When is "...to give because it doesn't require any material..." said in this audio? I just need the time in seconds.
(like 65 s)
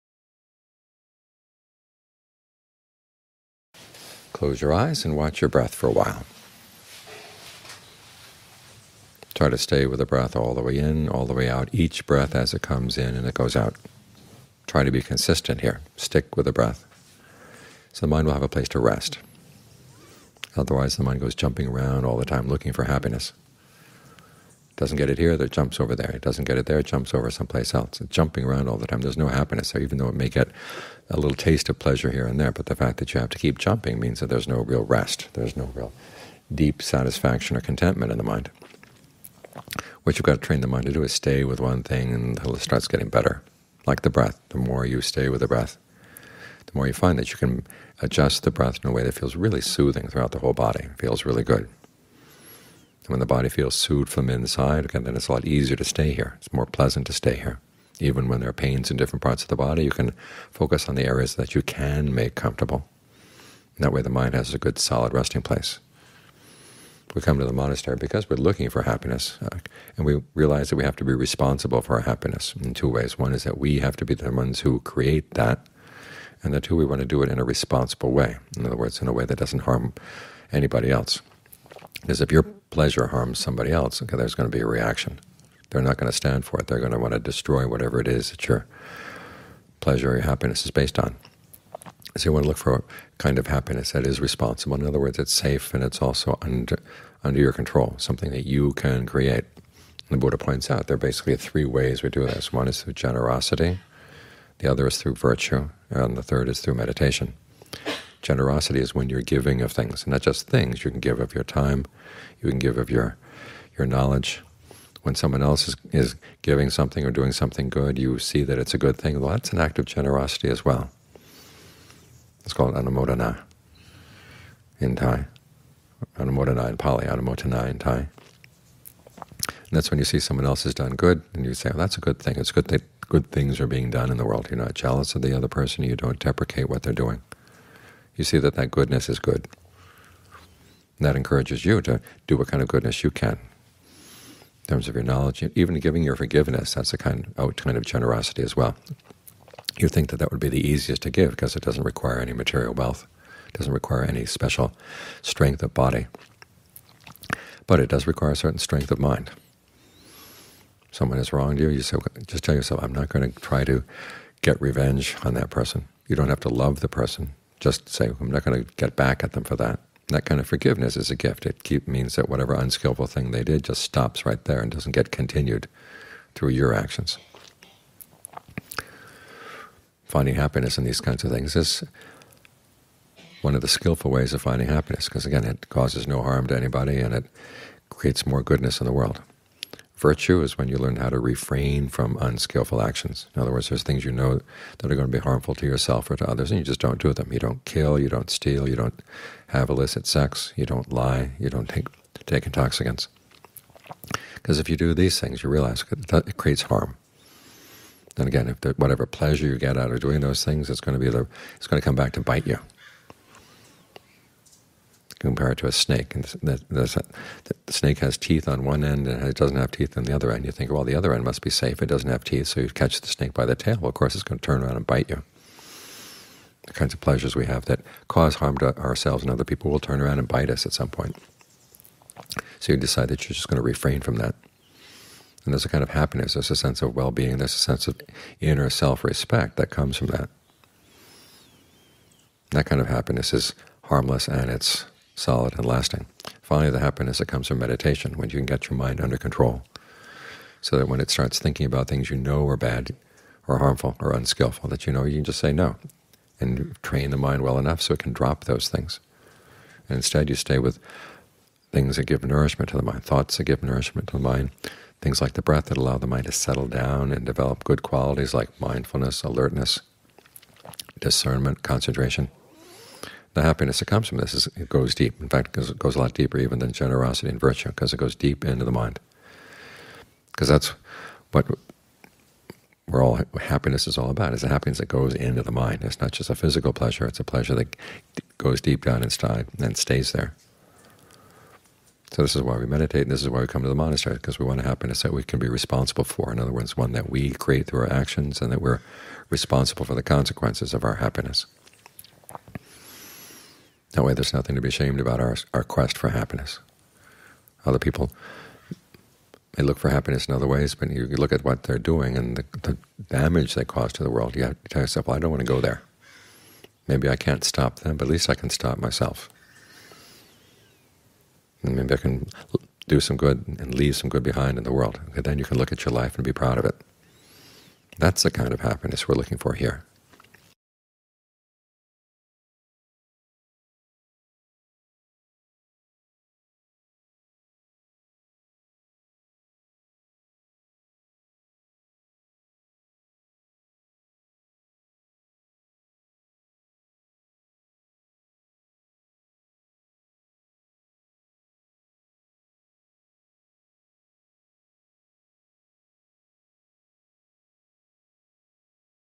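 151 s.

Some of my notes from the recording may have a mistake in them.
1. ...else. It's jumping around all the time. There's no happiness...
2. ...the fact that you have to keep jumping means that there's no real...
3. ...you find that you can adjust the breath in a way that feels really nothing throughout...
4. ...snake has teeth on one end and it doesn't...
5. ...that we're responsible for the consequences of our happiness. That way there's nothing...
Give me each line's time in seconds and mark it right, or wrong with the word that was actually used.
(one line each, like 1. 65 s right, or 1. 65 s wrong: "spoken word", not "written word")
1. 27 s right
2. 32 s right
3. 46 s wrong: "soothing", not "nothing"
4. 217 s right
5. 298 s right.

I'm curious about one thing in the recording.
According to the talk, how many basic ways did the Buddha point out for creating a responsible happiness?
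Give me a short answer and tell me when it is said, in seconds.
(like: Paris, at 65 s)
3, at 101 s.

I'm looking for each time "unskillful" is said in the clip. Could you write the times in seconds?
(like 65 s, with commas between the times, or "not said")
172 s, 192 s, 254 s.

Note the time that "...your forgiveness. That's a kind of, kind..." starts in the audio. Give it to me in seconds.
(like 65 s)
146 s.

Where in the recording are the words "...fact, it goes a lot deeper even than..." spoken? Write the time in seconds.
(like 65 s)
275 s.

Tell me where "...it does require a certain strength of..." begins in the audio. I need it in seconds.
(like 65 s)
157 s.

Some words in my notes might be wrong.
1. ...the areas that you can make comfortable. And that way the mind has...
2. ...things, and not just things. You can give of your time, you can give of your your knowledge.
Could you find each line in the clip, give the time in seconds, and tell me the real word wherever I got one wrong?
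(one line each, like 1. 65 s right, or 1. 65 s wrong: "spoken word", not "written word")
1. 60 s right
2. 109 s right.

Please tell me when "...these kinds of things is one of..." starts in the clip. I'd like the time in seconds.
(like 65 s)
180 s.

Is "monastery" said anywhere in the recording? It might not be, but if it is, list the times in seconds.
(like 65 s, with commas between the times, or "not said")
67 s, 293 s.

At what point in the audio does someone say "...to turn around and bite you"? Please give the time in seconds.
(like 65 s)
224 s.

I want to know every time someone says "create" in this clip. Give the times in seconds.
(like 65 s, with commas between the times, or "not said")
74 s, 99 s, 187 s, 206 s, 297 s.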